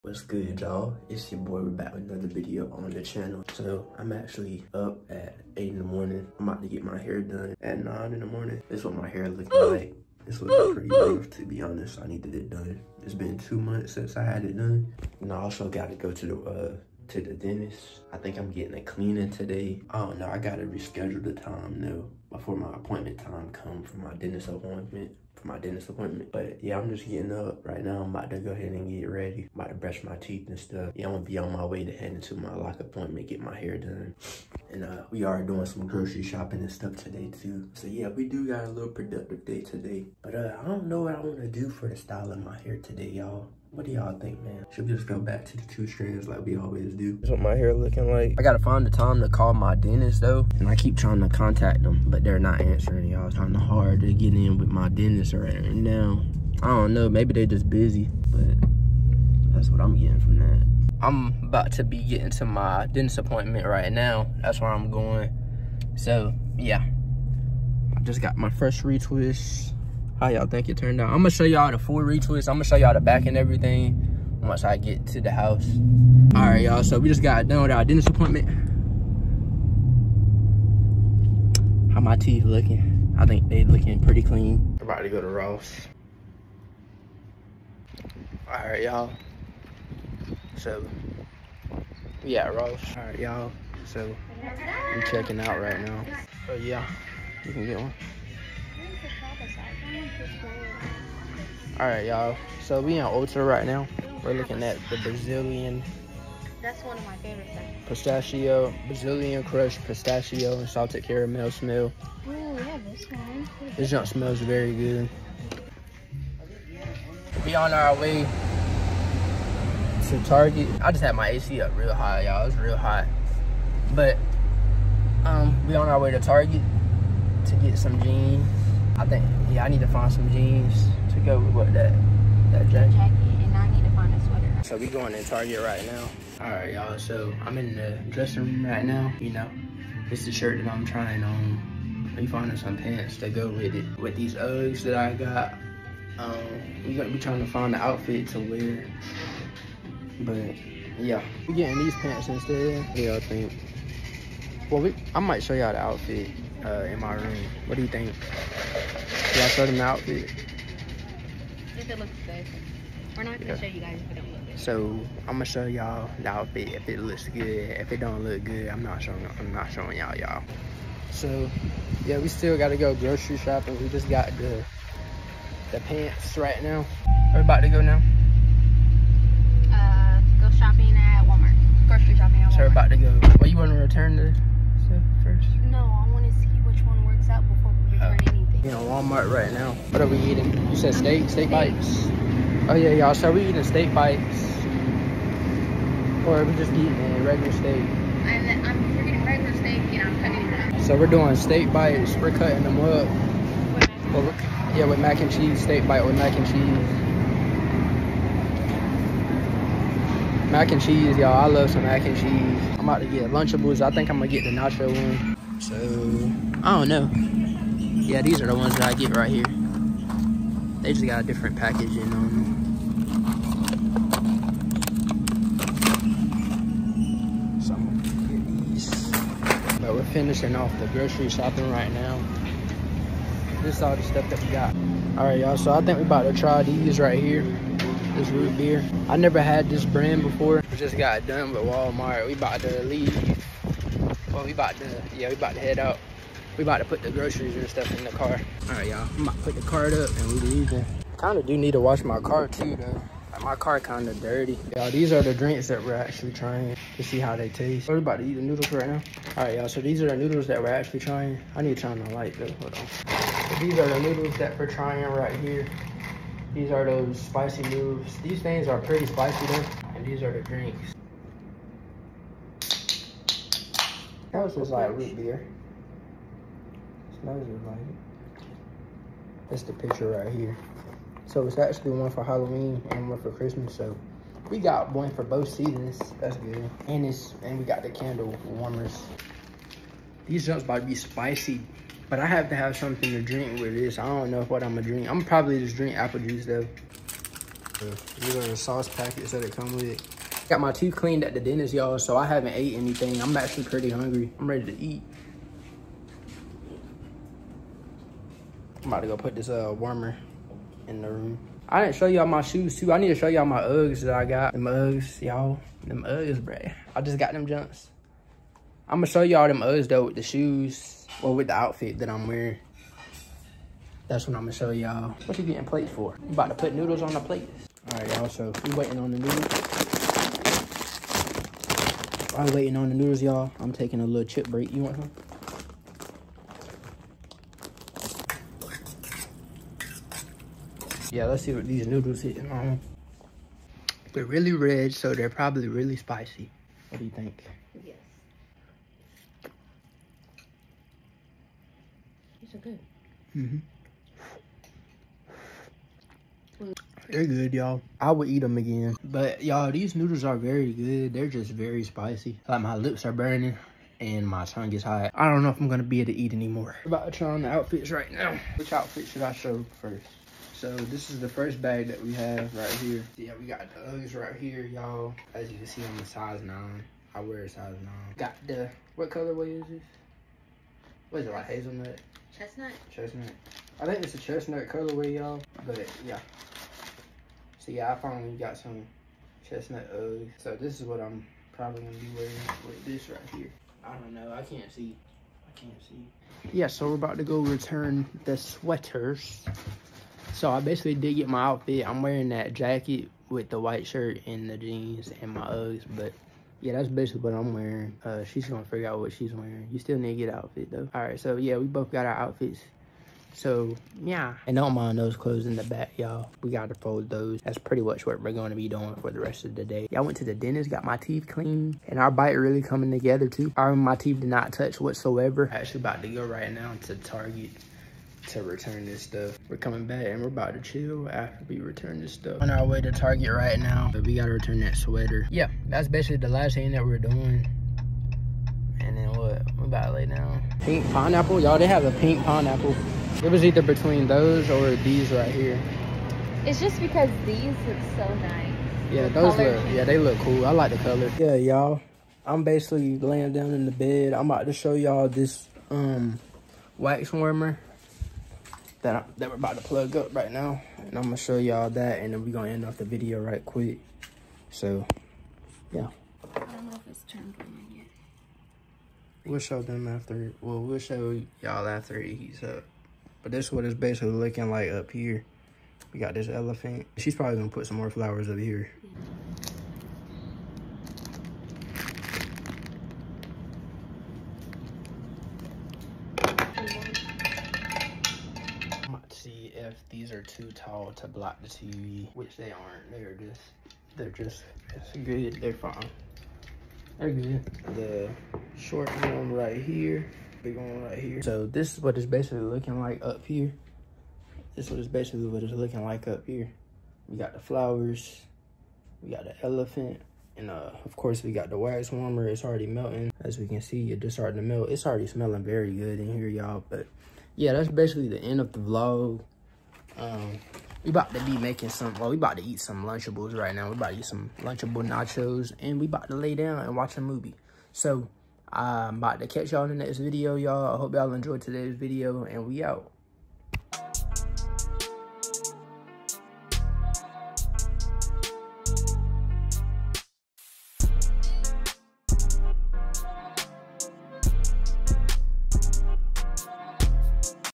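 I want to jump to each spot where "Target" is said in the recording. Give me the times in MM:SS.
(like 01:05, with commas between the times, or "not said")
02:00, 02:06, 02:15, 07:06, 07:12.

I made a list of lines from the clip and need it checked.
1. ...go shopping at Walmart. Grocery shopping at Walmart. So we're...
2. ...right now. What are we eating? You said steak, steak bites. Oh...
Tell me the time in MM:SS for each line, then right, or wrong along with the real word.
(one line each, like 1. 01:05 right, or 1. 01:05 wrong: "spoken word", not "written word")
1. 03:00 right
2. 03:09 right.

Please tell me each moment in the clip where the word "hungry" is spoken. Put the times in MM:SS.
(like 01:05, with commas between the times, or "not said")
05:03.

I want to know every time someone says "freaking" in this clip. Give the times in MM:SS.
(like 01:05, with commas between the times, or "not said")
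03:18.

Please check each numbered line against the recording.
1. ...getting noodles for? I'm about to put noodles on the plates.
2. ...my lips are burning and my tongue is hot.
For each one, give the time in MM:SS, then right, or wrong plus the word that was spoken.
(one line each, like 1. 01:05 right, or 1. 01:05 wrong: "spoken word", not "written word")
1. 05:25 wrong: "plates", not "noodles"
2. 06:02 right.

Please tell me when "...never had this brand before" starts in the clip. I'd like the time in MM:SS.
03:59.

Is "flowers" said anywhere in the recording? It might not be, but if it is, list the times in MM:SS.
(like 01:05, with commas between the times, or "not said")
07:57, 08:27.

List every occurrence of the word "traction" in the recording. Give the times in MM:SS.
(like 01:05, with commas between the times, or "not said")
not said.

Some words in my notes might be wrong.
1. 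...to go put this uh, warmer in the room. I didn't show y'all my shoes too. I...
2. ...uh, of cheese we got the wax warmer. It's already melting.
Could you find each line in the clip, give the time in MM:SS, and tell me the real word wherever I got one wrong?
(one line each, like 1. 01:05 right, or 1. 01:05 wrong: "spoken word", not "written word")
1. 05:09 right
2. 08:30 wrong: "course", not "cheese".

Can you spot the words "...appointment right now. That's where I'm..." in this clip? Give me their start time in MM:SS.
01:03.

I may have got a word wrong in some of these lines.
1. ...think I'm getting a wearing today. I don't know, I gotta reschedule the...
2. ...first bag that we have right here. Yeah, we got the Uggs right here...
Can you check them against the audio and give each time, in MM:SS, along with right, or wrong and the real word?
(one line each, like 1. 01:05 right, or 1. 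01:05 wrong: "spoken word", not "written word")
1. 00:18 wrong: "cleaning", not "wearing"
2. 06:11 right.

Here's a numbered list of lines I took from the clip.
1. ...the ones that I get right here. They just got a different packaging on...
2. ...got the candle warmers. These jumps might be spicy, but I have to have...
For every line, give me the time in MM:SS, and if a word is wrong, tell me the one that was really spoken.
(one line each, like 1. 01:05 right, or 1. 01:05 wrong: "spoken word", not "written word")
1. 03:38 right
2. 04:47 right.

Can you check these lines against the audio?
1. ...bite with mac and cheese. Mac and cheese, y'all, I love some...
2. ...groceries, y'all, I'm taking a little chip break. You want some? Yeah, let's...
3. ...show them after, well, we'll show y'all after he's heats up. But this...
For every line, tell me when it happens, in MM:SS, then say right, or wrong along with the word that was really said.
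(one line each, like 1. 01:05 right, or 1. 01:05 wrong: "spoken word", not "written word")
1. 03:25 right
2. 05:32 wrong: "noodles", not "groceries"
3. 07:49 right.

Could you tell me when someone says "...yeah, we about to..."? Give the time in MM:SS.
04:05.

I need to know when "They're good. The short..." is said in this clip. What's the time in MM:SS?
08:16.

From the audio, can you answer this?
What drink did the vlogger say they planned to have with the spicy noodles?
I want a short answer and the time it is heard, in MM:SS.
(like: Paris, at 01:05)
Apple juice, at 04:55.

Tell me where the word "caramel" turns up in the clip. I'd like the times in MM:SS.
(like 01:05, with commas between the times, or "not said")
01:51.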